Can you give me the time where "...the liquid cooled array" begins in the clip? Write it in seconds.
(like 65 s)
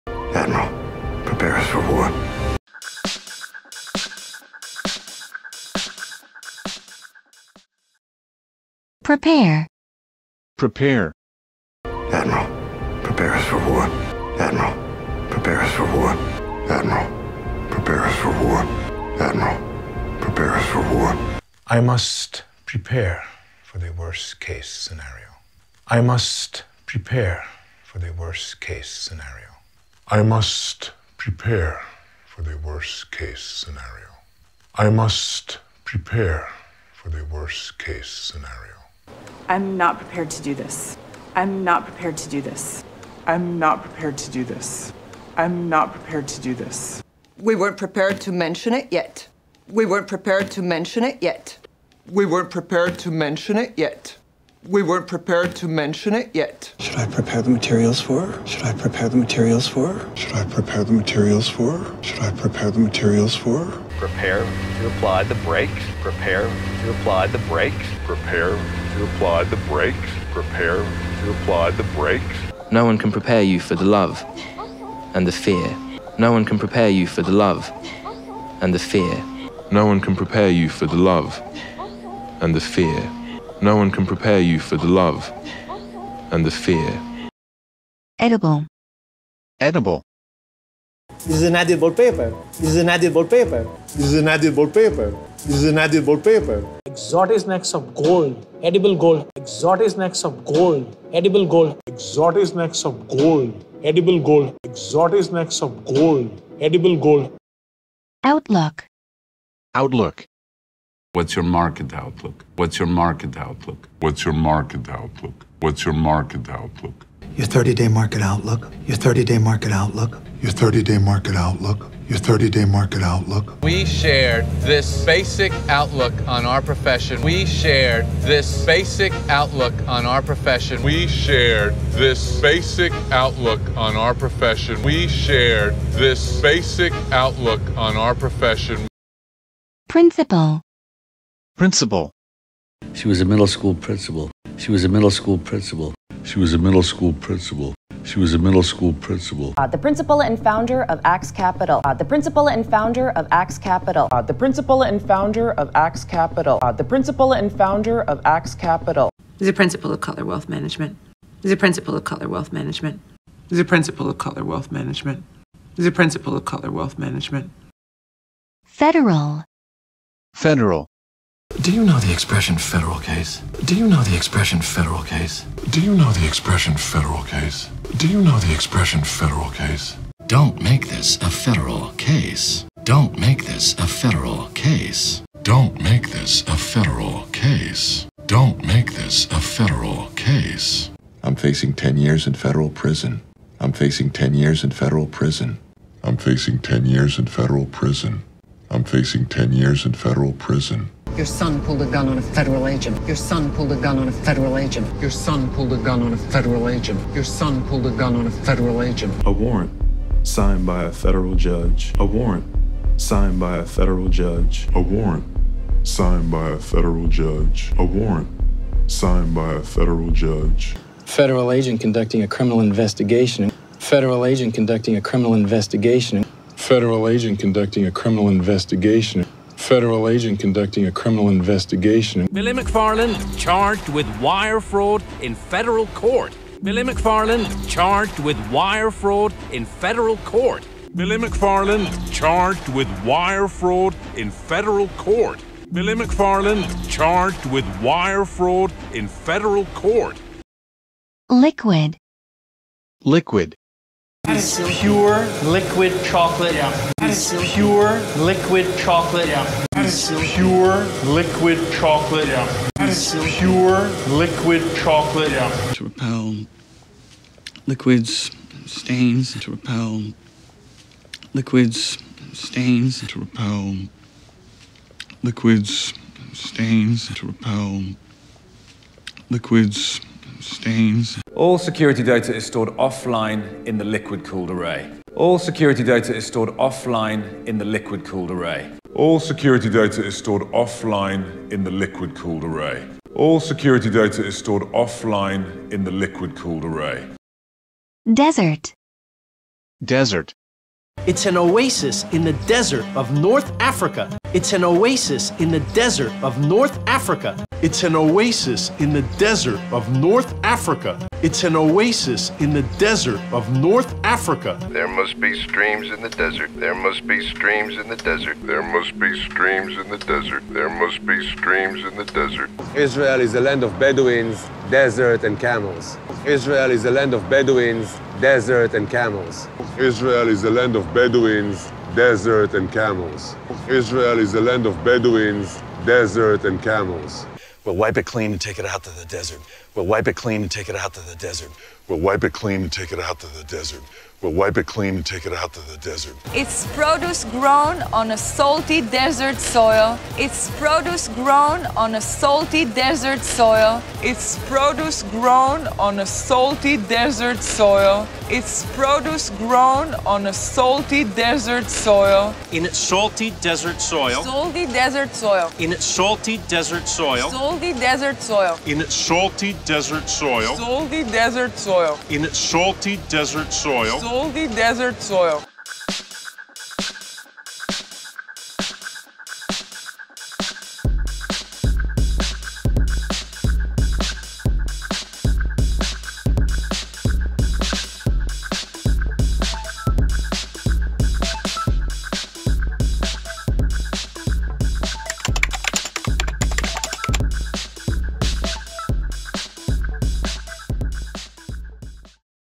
283 s.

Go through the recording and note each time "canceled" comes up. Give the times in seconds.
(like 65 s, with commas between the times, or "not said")
not said.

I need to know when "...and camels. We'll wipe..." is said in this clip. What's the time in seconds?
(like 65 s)
336 s.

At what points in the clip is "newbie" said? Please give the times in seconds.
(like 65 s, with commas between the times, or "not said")
not said.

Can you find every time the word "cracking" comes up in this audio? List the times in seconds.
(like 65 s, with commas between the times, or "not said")
not said.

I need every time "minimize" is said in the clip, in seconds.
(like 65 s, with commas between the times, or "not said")
not said.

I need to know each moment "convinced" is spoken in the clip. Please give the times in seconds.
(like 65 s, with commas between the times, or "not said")
not said.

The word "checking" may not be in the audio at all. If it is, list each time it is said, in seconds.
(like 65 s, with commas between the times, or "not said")
not said.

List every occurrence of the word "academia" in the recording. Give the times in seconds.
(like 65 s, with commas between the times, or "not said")
not said.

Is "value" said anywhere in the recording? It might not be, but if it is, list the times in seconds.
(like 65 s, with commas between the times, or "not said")
not said.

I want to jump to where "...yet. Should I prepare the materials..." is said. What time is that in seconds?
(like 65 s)
56 s.